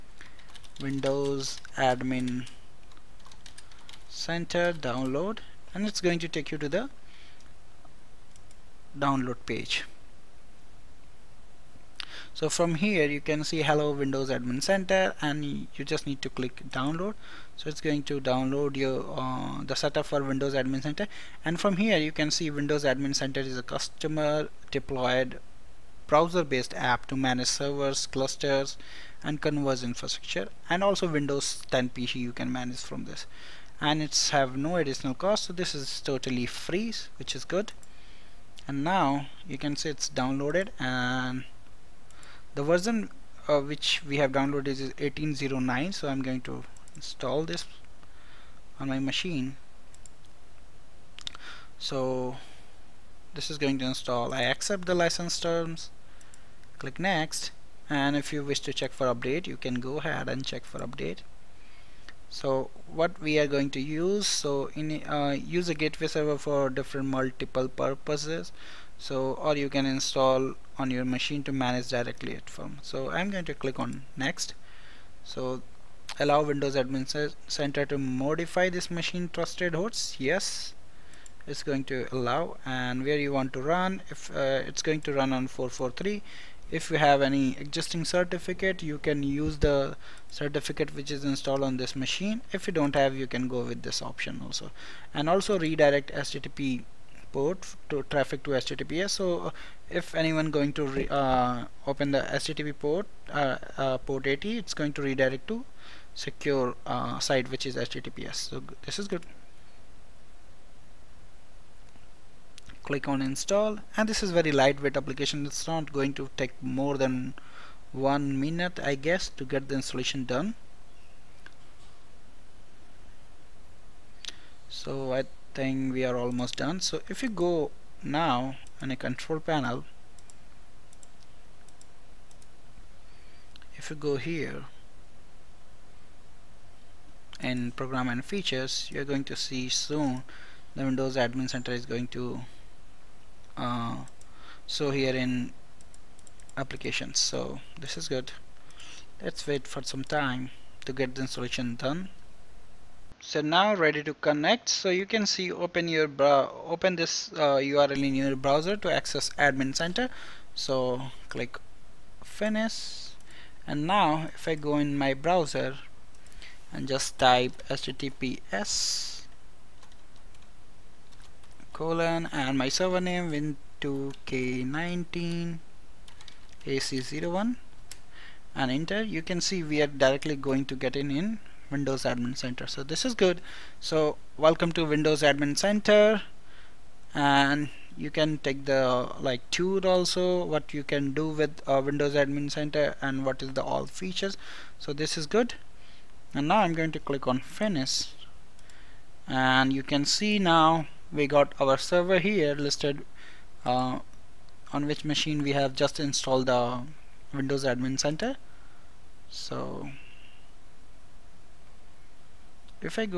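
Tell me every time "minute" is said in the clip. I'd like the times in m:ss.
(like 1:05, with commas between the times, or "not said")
1:58.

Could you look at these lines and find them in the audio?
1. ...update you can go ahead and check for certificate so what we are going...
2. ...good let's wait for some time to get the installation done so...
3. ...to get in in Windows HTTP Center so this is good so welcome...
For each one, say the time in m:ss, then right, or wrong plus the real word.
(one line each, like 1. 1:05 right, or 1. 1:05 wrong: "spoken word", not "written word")
1. 0:59 wrong: "update", not "certificate"
2. 2:28 right
3. 3:00 wrong: "Admin", not "HTTP".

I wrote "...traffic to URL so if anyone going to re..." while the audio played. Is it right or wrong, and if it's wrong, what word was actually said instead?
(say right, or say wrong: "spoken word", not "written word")
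wrong: "HTTPS", not "URL".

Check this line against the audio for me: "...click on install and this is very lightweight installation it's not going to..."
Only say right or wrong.
wrong.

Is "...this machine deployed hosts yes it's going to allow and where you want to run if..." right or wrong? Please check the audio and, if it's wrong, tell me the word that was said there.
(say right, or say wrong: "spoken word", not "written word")
wrong: "trusted", not "deployed".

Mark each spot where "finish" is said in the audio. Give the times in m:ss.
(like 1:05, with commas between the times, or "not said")
2:42, 3:17.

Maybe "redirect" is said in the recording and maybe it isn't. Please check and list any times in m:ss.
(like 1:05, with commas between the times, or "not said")
1:35, 1:45.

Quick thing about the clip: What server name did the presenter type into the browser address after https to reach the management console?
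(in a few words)
win2k19ac01.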